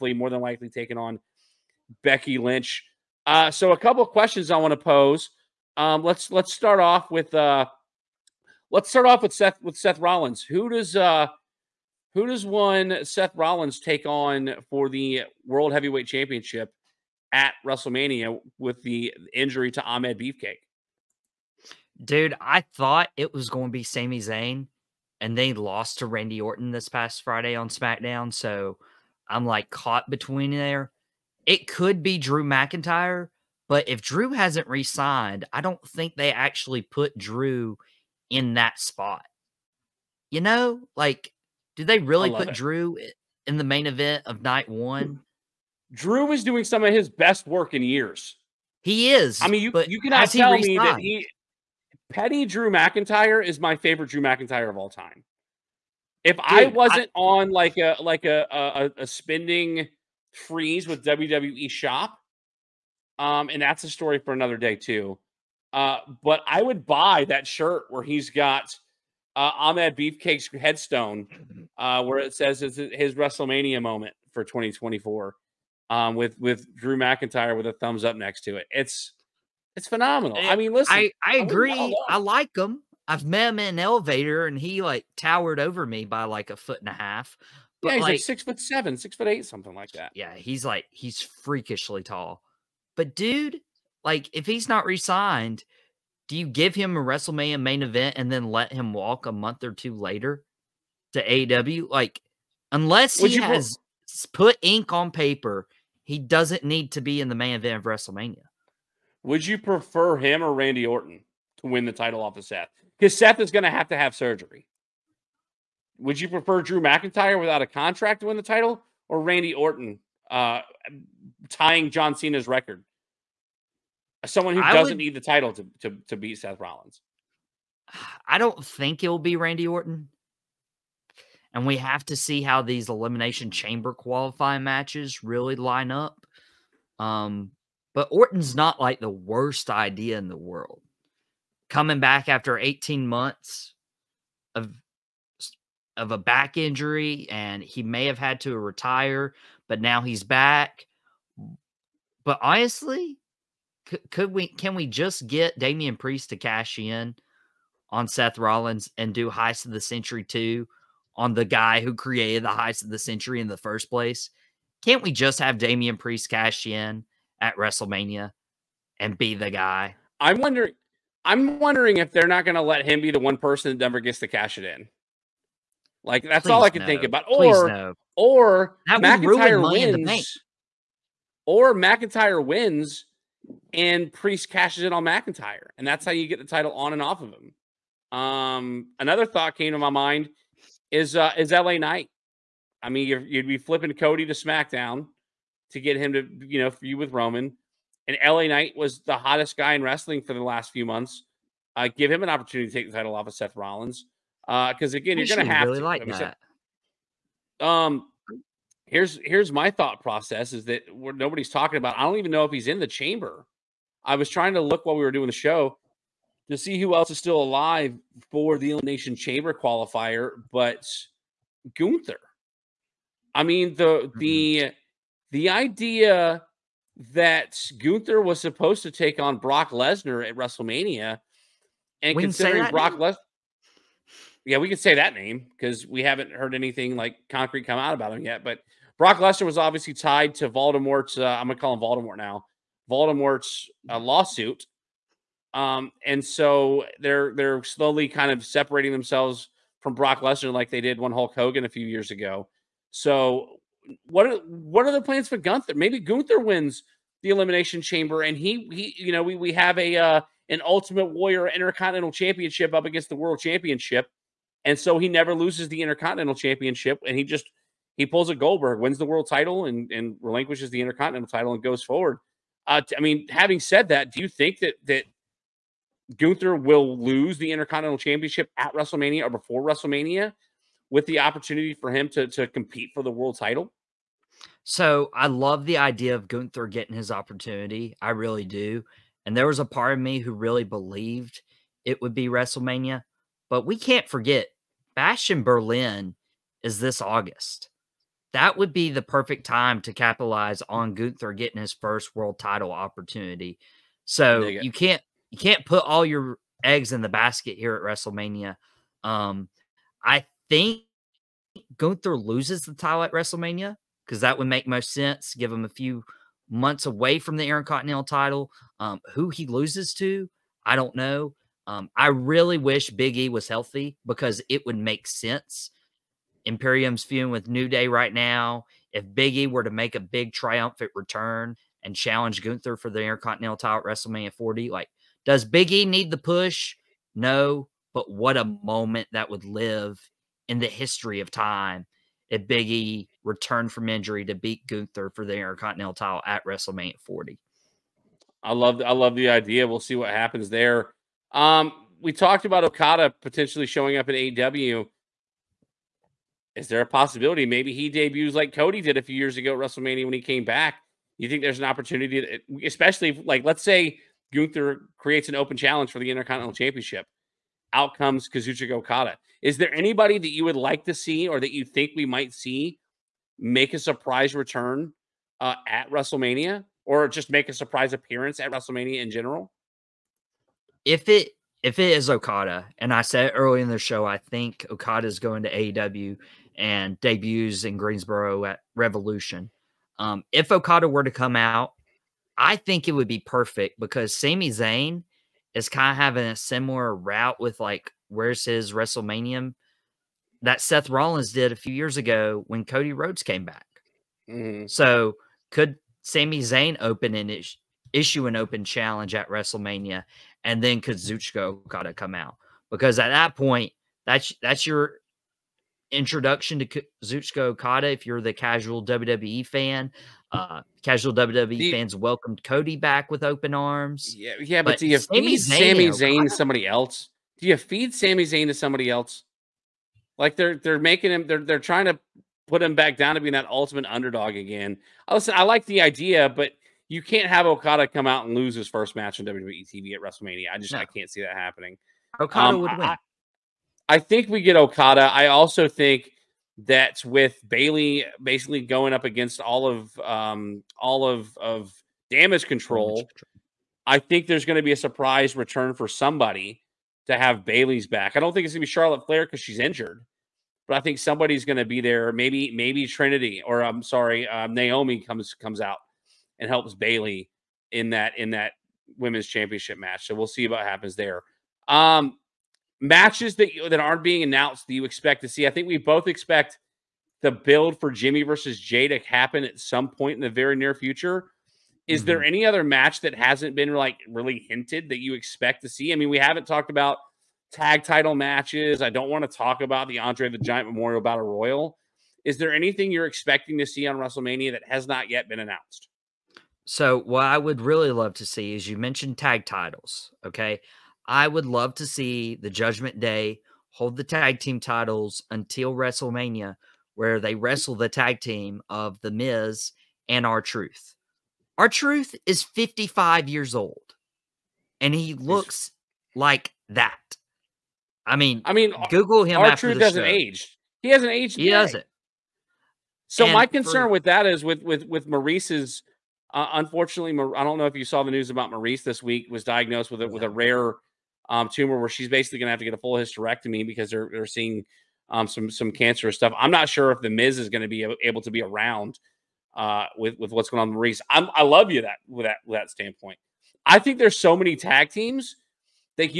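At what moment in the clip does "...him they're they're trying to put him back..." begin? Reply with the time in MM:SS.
07:11.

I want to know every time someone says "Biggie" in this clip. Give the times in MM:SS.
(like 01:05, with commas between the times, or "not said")
05:29, 05:35, 05:42.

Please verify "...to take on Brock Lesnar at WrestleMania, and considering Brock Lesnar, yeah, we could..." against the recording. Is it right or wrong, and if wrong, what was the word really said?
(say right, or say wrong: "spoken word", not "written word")
right.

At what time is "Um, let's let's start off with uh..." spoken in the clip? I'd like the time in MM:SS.
00:05.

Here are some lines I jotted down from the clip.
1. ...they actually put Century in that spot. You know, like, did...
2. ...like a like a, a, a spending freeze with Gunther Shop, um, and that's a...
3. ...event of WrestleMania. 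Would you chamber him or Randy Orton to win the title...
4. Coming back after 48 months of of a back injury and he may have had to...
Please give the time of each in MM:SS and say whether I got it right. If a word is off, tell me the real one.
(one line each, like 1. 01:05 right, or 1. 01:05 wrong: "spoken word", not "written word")
1. 00:36 wrong: "Drew", not "Century"
2. 00:57 wrong: "WWE", not "Gunther"
3. 01:47 wrong: "prefer", not "chamber"
4. 02:21 wrong: "18", not "48".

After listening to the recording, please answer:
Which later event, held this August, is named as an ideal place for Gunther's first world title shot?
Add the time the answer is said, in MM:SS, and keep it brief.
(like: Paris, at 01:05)
Bash in Berlin, at 04:54.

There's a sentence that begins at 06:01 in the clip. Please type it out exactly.
You think there's an opportunity, that, especially if, like let's say Gunther creates an open challenge for the Intercontinental Championship.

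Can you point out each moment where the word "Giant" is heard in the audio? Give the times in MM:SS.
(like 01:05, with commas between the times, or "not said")
08:10.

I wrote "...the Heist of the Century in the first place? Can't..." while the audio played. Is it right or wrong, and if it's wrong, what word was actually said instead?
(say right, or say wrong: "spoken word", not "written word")
right.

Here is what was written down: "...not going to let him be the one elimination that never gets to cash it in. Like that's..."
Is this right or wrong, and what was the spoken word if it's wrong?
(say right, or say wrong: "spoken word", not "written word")
wrong: "person", not "elimination".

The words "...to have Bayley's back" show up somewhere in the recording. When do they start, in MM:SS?
07:37.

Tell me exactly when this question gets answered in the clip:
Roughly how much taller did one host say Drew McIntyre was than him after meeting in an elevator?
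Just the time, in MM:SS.
01:26.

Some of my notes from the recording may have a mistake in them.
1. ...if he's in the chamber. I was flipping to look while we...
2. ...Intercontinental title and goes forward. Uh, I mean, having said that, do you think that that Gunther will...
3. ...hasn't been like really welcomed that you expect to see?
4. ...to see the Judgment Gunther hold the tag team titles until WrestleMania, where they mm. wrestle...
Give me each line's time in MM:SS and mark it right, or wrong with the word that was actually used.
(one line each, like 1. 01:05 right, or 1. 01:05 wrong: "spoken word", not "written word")
1. 03:32 wrong: "trying", not "flipping"
2. 04:30 right
3. 08:03 wrong: "hinted", not "welcomed"
4. 08:21 wrong: "Day", not "Gunther".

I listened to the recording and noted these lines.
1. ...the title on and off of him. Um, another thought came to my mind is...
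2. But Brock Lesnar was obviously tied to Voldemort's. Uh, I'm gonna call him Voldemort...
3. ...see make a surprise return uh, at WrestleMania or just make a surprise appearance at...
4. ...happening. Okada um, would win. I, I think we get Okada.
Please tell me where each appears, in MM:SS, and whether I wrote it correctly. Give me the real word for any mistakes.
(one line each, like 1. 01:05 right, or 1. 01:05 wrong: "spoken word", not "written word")
1. 03:06 right
2. 03:58 right
3. 06:12 right
4. 07:21 right.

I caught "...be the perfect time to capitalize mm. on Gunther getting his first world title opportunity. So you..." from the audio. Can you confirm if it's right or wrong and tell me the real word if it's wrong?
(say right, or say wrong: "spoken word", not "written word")
right.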